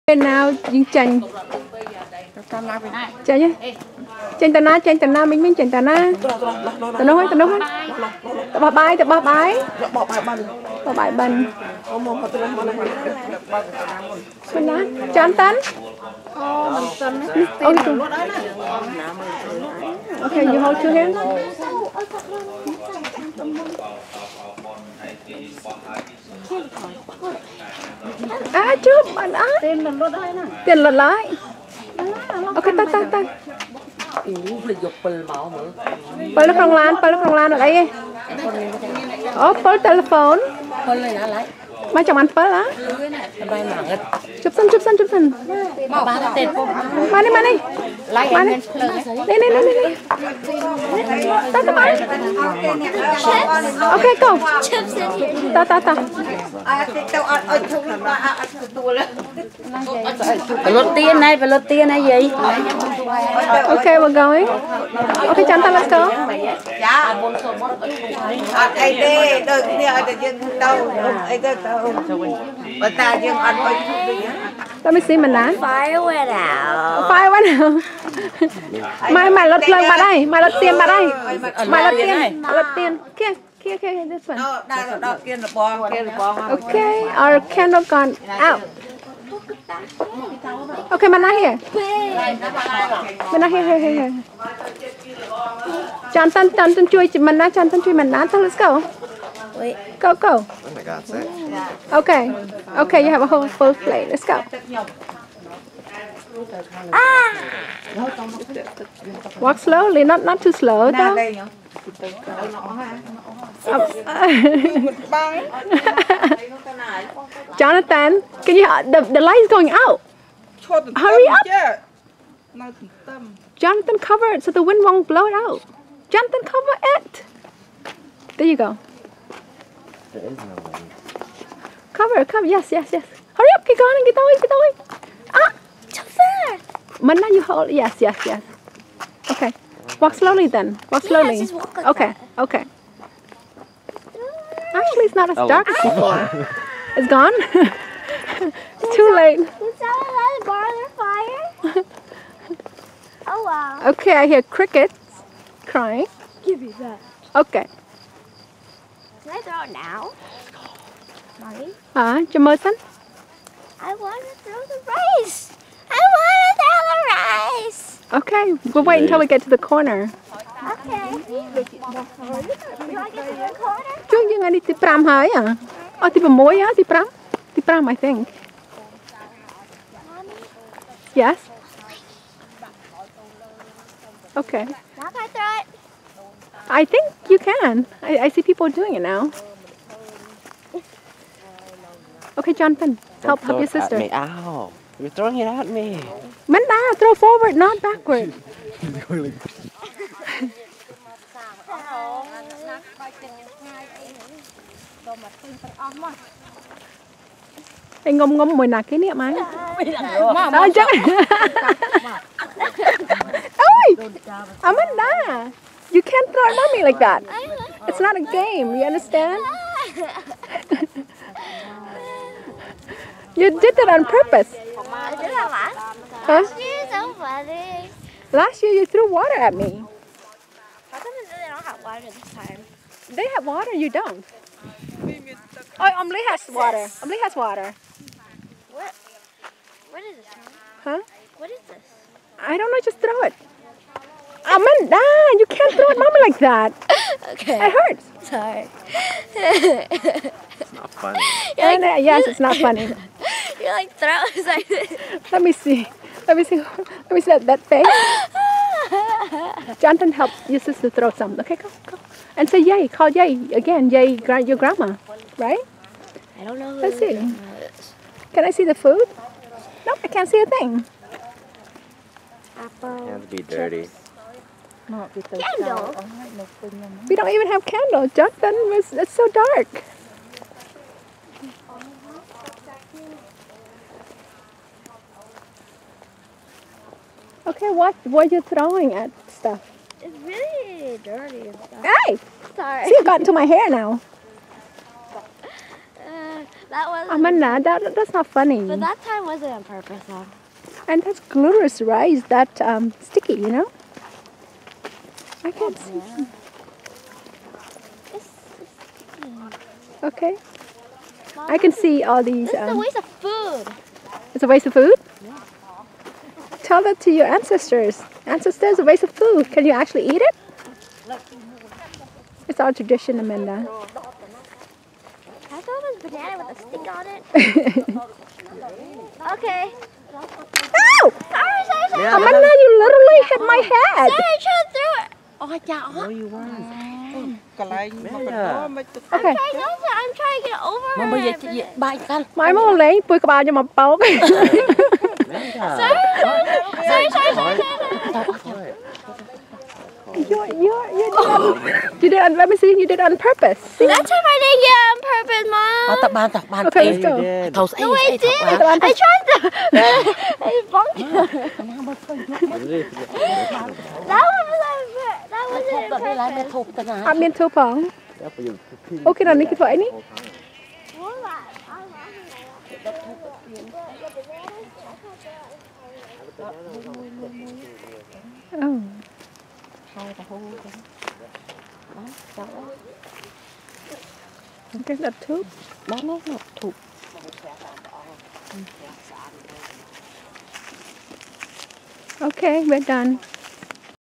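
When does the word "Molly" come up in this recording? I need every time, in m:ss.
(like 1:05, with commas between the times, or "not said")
2:41.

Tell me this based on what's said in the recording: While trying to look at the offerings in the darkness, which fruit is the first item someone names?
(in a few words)
Apple.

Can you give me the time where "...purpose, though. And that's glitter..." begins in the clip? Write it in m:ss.
4:59.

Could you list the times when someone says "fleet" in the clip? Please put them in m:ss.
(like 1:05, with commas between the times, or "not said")
not said.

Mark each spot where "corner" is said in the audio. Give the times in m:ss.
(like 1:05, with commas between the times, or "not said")
2:49.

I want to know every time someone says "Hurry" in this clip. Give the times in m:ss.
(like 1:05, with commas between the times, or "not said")
2:00, 2:13.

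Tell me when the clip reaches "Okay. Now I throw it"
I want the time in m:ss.
3:04.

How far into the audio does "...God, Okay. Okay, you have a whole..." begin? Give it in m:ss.
1:40.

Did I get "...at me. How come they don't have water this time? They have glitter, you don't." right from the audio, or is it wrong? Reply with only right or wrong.
wrong.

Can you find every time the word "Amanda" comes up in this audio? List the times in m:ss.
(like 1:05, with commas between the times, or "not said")
3:34, 4:04, 4:57, 5:23, 5:32.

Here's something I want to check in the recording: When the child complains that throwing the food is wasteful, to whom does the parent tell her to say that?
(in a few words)
your ancestors.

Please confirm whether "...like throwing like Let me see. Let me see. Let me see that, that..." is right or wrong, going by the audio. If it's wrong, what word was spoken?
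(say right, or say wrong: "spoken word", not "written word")
right.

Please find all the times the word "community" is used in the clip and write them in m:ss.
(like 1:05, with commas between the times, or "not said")
not said.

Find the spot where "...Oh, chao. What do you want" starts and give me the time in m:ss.
5:35.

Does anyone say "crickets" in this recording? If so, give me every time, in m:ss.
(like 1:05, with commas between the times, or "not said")
2:34.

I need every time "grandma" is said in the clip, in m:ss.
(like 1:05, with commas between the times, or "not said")
4:24.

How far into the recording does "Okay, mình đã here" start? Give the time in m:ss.
1:30.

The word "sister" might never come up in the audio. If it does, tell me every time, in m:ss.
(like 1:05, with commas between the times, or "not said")
3:13, 4:20.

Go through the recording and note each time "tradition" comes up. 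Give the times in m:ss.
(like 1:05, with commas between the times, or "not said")
5:22.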